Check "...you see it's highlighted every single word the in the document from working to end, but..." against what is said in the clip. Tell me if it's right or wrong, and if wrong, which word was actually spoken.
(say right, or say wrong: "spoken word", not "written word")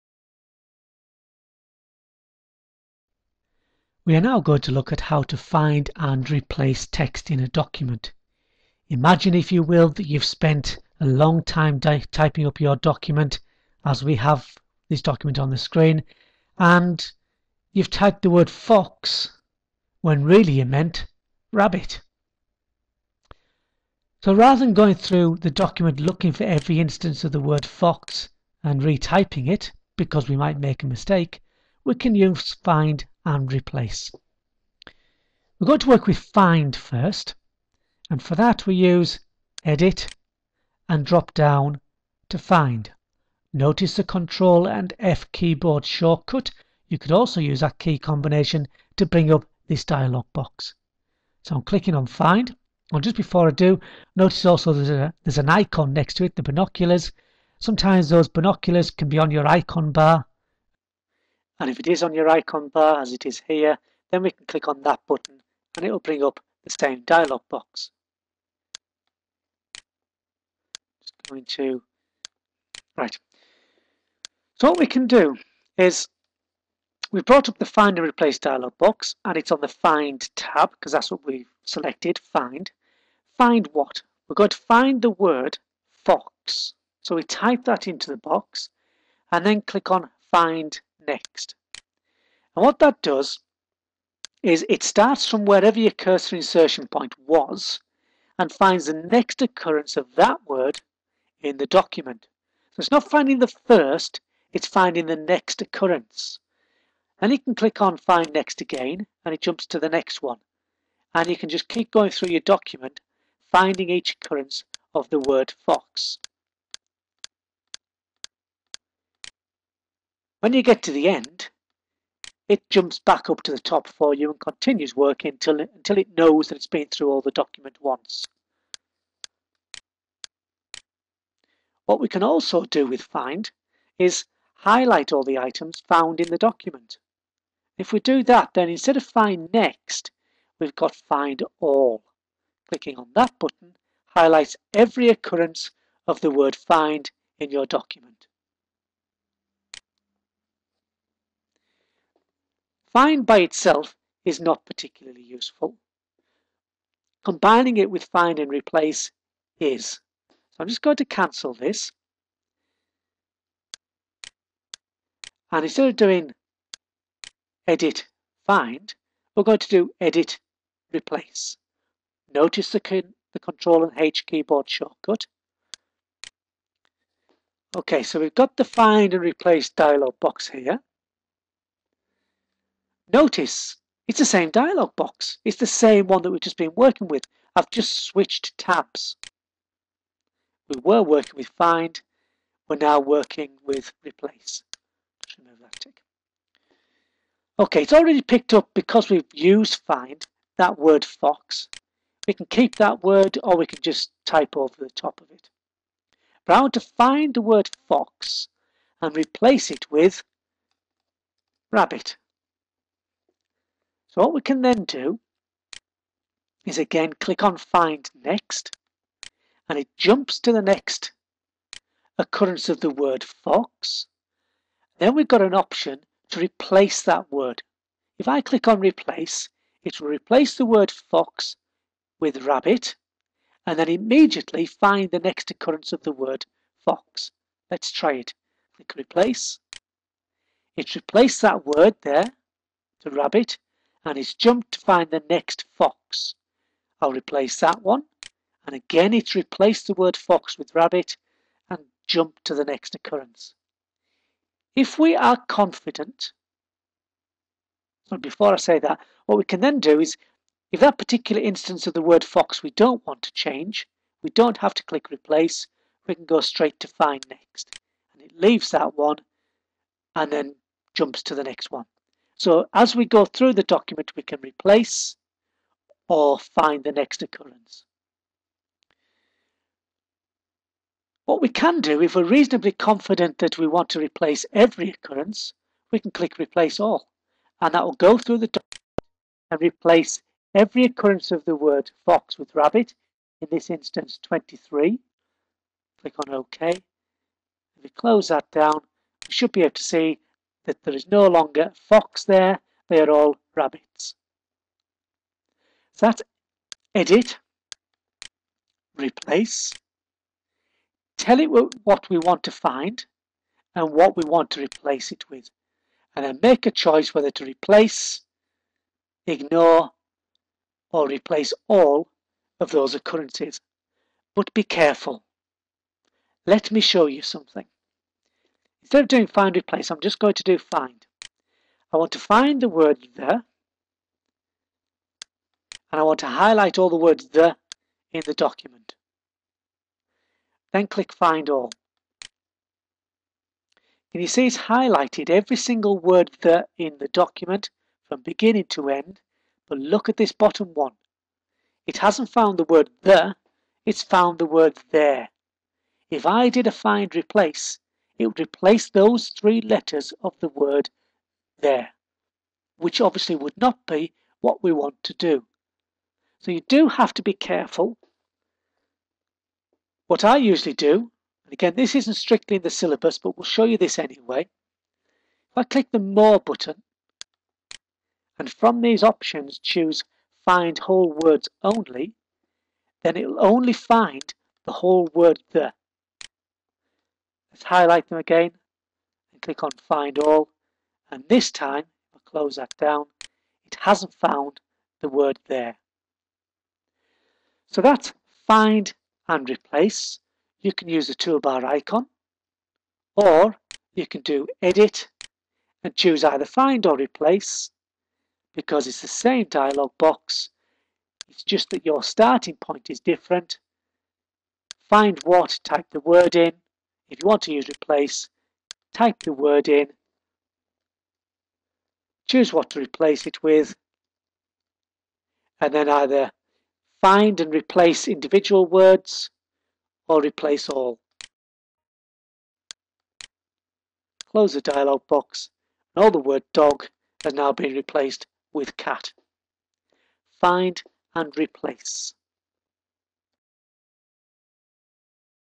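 wrong: "beginning", not "working".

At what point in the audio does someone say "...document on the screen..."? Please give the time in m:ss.
0:15.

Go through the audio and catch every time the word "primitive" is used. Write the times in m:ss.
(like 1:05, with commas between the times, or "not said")
not said.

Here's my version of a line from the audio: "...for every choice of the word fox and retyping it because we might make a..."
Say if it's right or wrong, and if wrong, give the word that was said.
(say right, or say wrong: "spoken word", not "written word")
wrong: "instance", not "choice".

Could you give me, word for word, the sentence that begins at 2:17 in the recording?
If we do that, then instead of find next, we've got find all.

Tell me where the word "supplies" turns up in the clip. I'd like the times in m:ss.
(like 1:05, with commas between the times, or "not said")
not said.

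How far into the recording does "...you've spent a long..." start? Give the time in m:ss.
0:10.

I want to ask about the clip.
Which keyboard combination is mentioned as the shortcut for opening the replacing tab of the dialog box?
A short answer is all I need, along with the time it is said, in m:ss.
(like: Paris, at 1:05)
Control and H, at 2:53.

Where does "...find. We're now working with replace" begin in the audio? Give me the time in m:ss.
3:11.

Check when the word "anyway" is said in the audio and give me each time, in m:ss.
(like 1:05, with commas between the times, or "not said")
6:13.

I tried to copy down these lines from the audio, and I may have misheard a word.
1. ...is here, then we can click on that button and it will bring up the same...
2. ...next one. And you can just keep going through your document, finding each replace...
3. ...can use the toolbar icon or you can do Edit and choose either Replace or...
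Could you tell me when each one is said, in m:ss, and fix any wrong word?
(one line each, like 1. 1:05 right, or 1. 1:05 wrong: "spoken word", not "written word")
1. 1:03 right
2. 1:49 wrong: "occurrence", not "replace"
3. 6:40 wrong: "Find", not "Replace".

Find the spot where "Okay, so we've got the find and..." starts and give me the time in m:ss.
2:57.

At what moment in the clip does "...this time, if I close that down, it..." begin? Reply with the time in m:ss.
6:31.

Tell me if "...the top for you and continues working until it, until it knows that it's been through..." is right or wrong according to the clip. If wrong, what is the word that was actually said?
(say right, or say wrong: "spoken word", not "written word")
right.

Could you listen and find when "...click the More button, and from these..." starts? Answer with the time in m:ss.
6:15.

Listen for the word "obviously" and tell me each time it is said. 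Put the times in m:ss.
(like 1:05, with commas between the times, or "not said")
6:03.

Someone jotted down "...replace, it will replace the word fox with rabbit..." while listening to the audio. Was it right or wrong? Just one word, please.
right.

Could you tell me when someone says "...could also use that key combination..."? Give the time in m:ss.
0:46.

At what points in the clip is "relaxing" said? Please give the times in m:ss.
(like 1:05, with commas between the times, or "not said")
not said.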